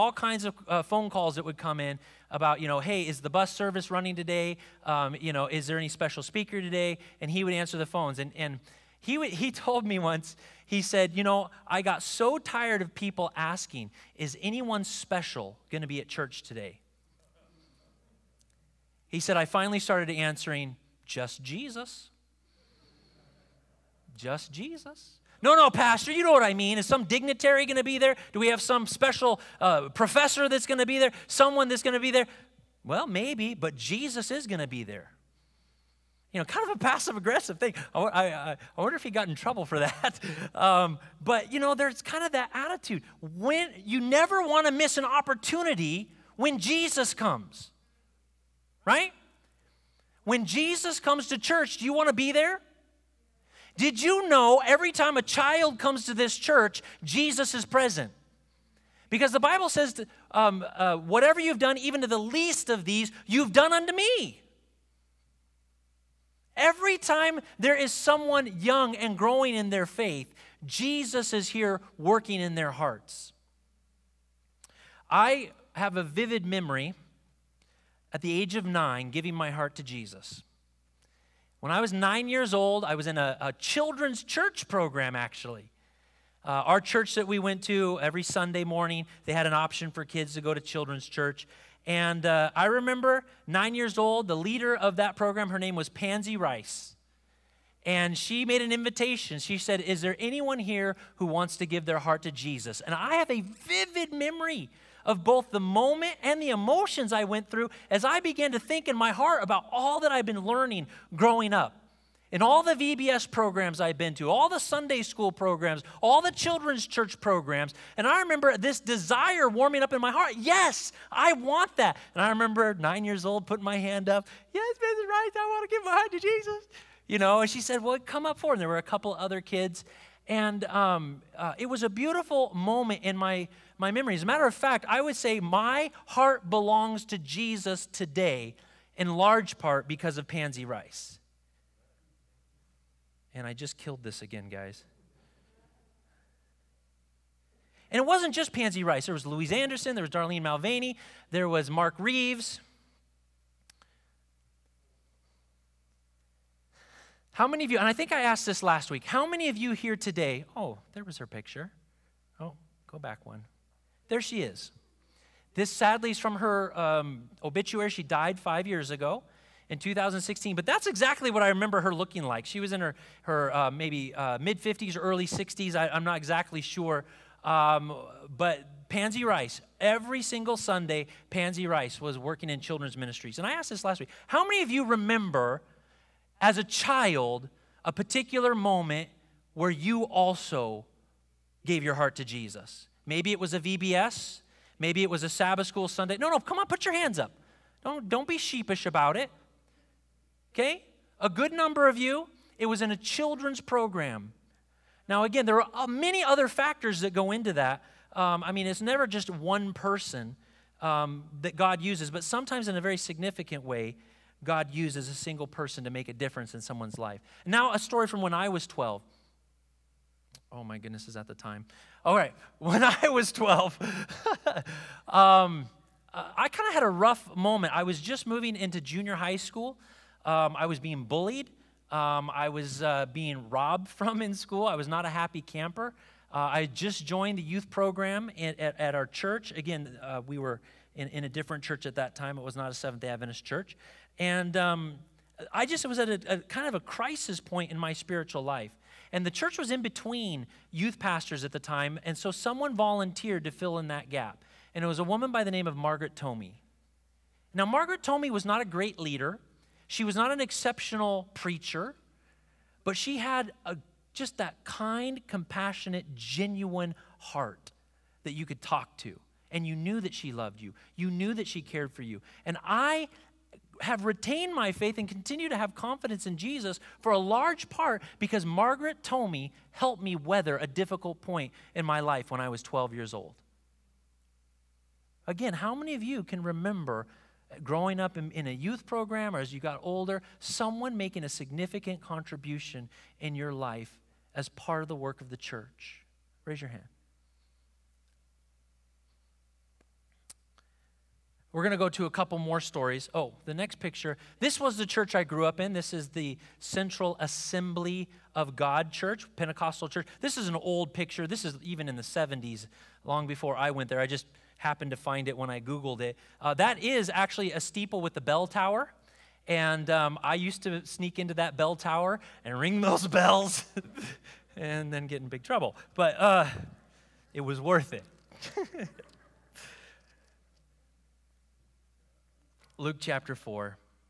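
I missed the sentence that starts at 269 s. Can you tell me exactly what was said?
And you knew that she loved you, you knew that she cared for you.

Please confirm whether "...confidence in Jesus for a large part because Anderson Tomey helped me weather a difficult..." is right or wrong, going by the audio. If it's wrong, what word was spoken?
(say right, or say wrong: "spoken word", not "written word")
wrong: "Margaret", not "Anderson".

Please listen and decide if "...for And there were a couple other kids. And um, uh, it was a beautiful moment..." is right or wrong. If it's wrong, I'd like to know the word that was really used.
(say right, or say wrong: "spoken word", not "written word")
right.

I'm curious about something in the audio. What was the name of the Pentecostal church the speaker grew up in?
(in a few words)
Central Assembly of God Church.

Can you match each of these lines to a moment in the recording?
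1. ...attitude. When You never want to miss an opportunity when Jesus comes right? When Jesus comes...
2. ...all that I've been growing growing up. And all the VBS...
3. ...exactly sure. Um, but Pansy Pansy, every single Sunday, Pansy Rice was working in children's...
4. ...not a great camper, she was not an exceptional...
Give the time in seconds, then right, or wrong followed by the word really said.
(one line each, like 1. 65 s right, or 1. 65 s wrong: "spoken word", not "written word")
1. 42 s right
2. 109 s wrong: "learning", not "growing"
3. 176 s wrong: "Rice", not "Pansy"
4. 258 s wrong: "leader", not "camper".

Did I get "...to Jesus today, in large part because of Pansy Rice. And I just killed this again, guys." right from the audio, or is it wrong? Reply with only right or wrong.
right.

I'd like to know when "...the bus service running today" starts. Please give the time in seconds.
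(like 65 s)
3 s.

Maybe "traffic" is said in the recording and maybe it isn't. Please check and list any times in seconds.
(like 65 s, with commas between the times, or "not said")
not said.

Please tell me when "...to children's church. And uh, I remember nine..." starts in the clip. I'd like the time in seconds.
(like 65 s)
90 s.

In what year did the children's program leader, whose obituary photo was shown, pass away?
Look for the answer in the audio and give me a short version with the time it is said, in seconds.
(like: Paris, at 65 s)
2016, at 169 s.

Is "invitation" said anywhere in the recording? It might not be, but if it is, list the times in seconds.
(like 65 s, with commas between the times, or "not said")
98 s.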